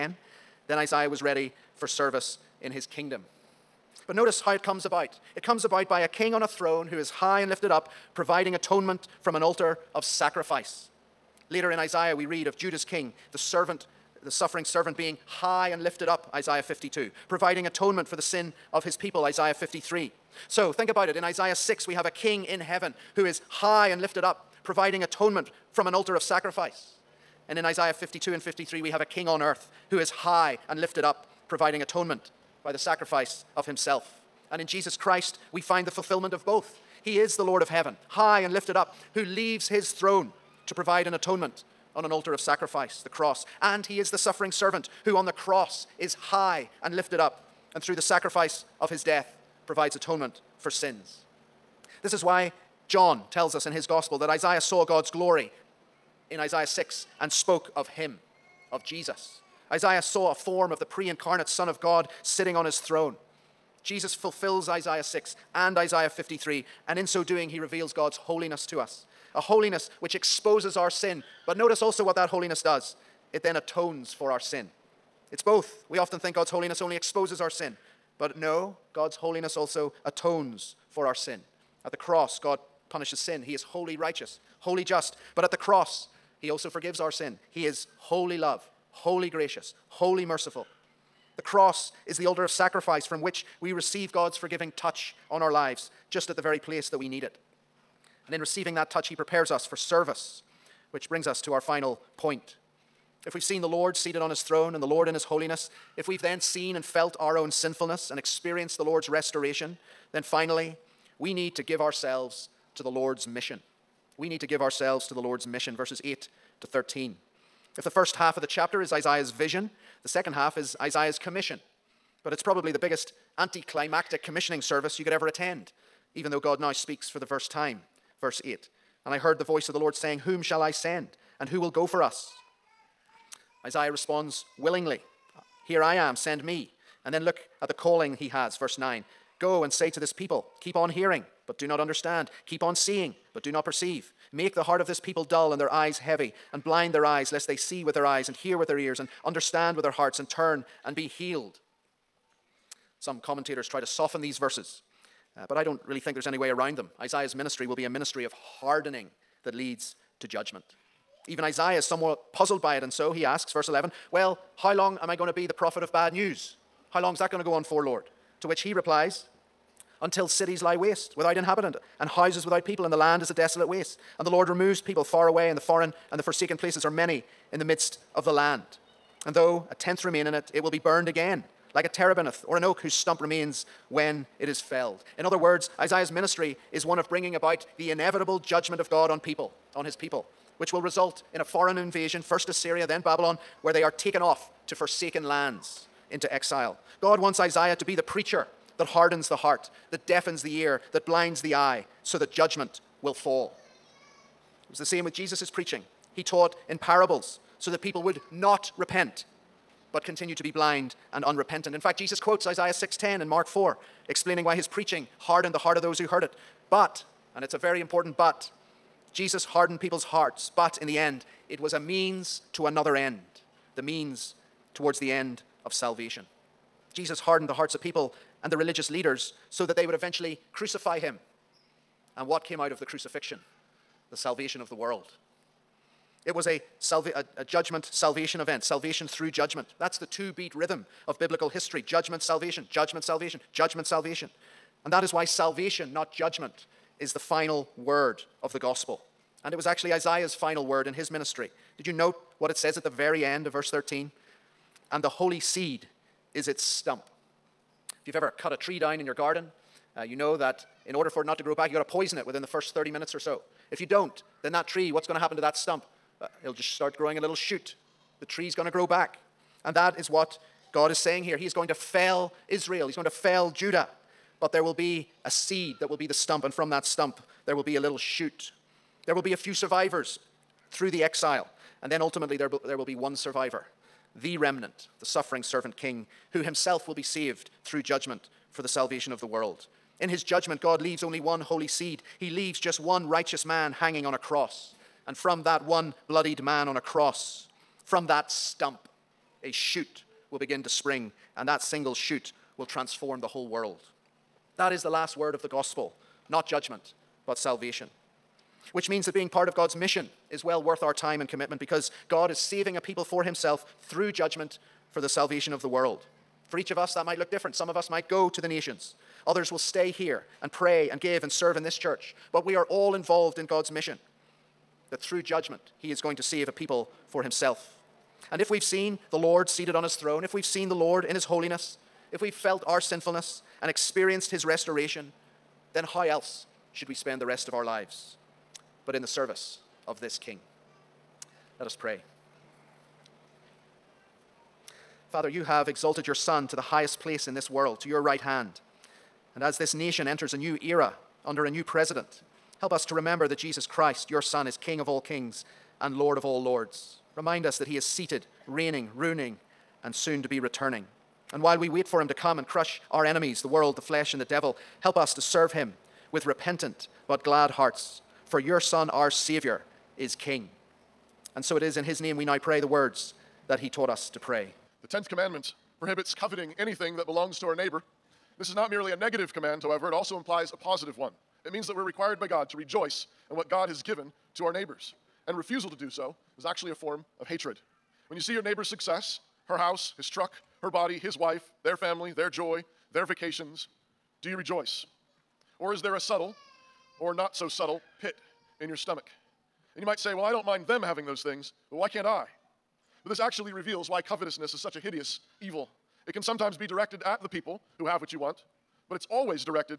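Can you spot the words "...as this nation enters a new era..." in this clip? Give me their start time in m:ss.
5:49.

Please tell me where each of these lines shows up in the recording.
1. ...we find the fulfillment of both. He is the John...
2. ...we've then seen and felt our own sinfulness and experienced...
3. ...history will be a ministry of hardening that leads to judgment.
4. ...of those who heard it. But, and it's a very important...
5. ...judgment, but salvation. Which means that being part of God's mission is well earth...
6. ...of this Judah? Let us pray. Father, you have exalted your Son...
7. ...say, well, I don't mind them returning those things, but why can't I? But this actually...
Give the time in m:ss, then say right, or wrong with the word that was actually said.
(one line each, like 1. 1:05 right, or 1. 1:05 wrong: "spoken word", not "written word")
1. 0:35 wrong: "Lord", not "John"
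2. 1:46 right
3. 2:37 wrong: "ministry", not "history"
4. 3:35 right
5. 5:06 wrong: "worth", not "earth"
6. 5:39 wrong: "King", not "Judah"
7. 6:39 wrong: "having", not "returning".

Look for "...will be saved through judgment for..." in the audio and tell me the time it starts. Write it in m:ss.
4:46.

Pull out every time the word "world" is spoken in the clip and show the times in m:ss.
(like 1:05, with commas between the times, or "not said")
3:54, 4:49, 5:03, 5:15, 5:47, 6:03.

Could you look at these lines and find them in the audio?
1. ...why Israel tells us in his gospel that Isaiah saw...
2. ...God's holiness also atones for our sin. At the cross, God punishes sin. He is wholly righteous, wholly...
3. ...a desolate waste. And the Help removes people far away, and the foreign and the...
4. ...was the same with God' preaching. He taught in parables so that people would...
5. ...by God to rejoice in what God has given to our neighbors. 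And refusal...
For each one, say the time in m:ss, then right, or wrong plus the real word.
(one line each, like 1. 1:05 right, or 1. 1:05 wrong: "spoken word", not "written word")
1. 0:52 wrong: "John", not "Israel"
2. 1:18 right
3. 2:53 wrong: "Lord", not "Help"
4. 3:24 wrong: "Jesus", not "God"
5. 6:22 right.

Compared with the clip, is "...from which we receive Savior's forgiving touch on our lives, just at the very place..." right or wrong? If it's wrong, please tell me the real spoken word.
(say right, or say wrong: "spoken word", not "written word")
wrong: "God", not "Savior".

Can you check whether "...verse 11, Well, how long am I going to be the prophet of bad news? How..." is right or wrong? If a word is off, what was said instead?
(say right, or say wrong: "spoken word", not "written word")
right.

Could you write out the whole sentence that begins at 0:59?
Isaiah saw a form of the pre incarnate Son of God sitting on his throne.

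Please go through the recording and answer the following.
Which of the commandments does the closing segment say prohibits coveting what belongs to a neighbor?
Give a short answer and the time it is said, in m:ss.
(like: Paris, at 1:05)
10th, at 6:14.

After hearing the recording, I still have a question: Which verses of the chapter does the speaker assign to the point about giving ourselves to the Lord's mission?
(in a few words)
Verses 8 to 13.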